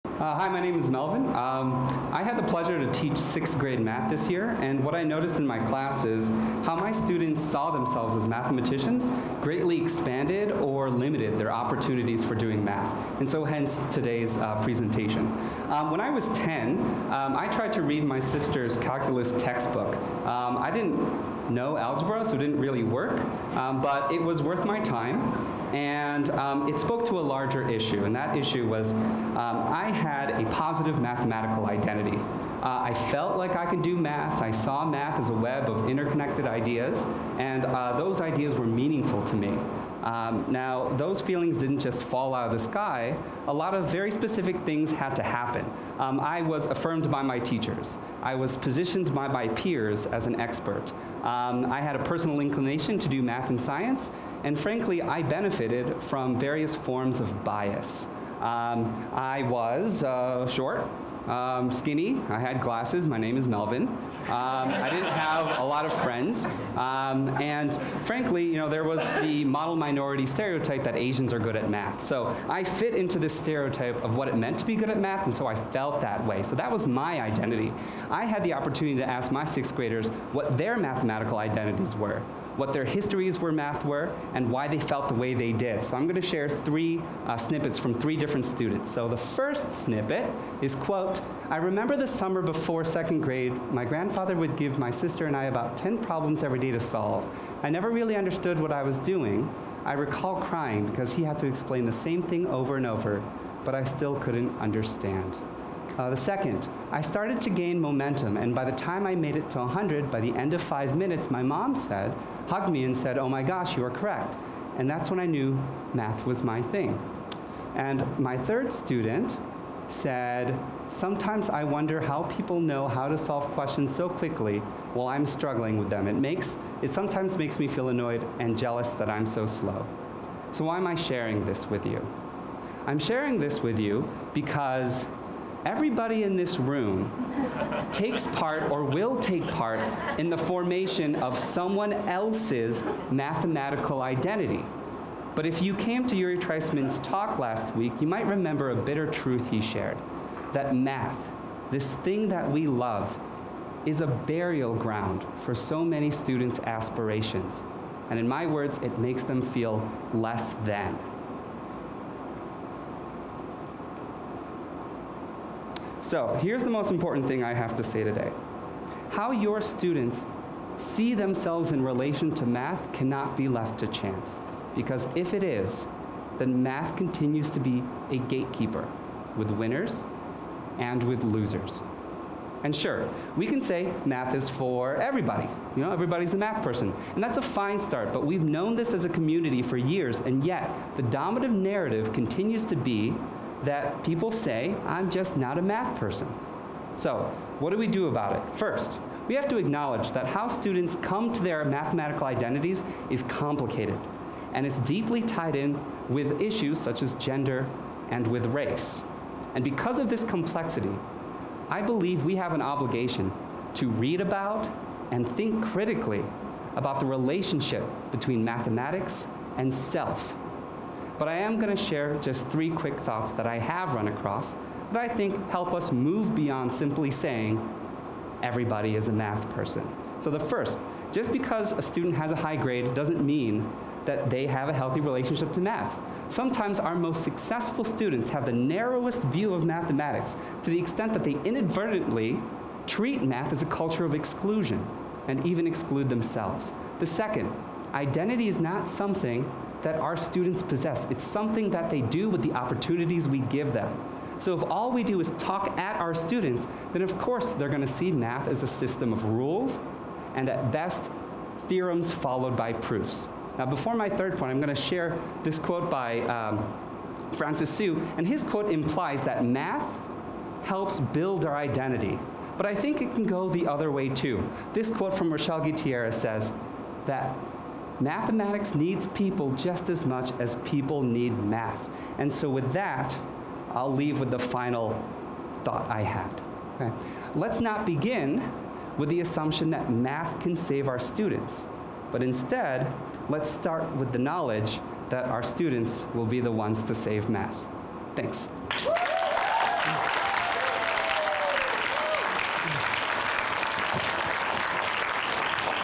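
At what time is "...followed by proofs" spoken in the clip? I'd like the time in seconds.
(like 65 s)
262 s.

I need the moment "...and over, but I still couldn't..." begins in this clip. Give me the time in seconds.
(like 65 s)
102 s.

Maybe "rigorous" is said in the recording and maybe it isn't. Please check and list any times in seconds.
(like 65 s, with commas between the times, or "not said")
not said.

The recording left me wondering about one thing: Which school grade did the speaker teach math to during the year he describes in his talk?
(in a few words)
sixth grade.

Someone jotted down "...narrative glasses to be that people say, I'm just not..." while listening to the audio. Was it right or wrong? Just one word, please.
wrong.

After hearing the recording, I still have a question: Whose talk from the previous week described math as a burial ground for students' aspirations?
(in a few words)
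Uri Treisman.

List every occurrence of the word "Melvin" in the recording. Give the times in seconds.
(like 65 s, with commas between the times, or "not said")
0 s, 63 s.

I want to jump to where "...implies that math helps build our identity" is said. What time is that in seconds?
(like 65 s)
268 s.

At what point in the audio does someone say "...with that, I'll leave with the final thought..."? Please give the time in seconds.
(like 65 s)
282 s.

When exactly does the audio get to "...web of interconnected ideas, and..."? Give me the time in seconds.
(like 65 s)
35 s.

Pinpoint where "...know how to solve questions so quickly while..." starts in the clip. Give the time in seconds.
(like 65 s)
122 s.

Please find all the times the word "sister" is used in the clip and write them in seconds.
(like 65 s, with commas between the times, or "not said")
18 s, 94 s.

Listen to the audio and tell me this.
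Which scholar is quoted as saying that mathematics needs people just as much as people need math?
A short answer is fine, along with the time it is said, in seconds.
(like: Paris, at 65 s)
Rochelle Gutierrez, at 275 s.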